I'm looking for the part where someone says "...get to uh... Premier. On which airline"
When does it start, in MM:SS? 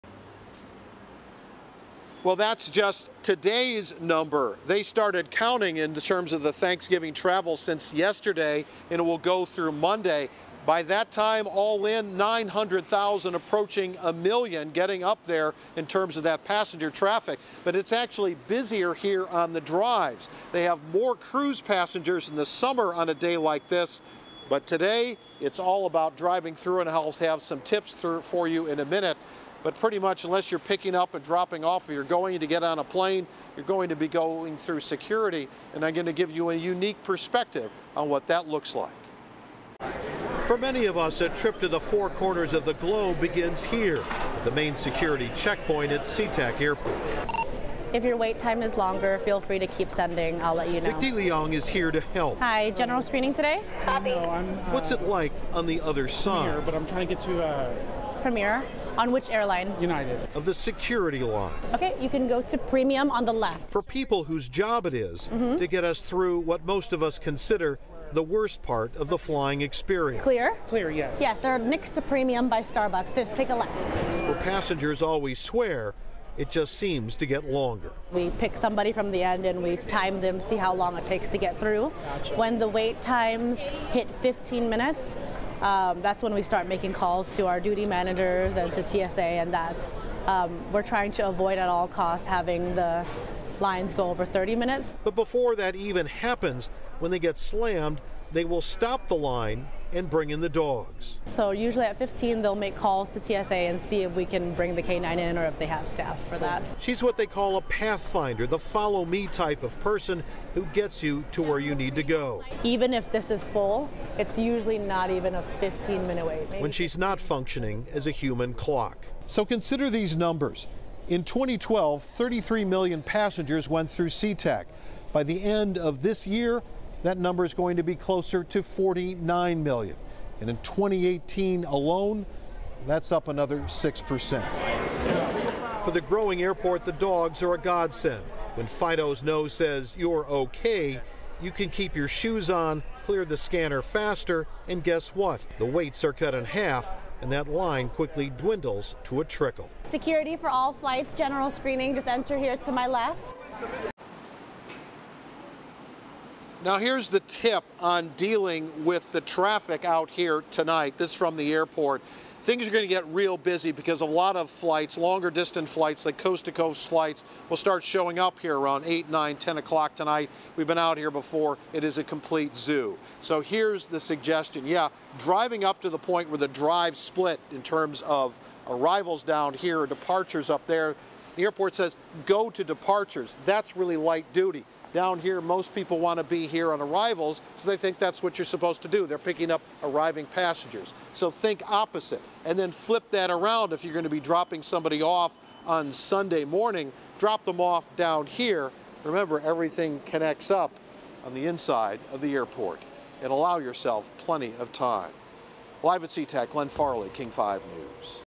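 00:57.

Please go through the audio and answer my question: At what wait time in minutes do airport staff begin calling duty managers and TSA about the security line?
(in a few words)
15.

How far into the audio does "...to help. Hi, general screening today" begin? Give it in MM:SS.
00:51.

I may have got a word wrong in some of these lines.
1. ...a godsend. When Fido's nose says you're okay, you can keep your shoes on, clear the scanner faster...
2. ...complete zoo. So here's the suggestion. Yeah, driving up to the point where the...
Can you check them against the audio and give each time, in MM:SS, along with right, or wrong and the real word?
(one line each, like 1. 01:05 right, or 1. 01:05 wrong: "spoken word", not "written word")
1. 02:17 right
2. 02:52 right.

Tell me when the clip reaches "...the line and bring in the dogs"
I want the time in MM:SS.
01:39.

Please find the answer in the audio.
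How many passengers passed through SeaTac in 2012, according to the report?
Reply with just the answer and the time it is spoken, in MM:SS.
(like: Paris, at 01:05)
33 million, at 02:02.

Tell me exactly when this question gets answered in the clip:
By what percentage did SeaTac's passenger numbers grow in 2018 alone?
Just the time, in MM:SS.
02:13.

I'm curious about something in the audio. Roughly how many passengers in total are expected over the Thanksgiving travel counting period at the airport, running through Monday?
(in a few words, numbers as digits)
900,000.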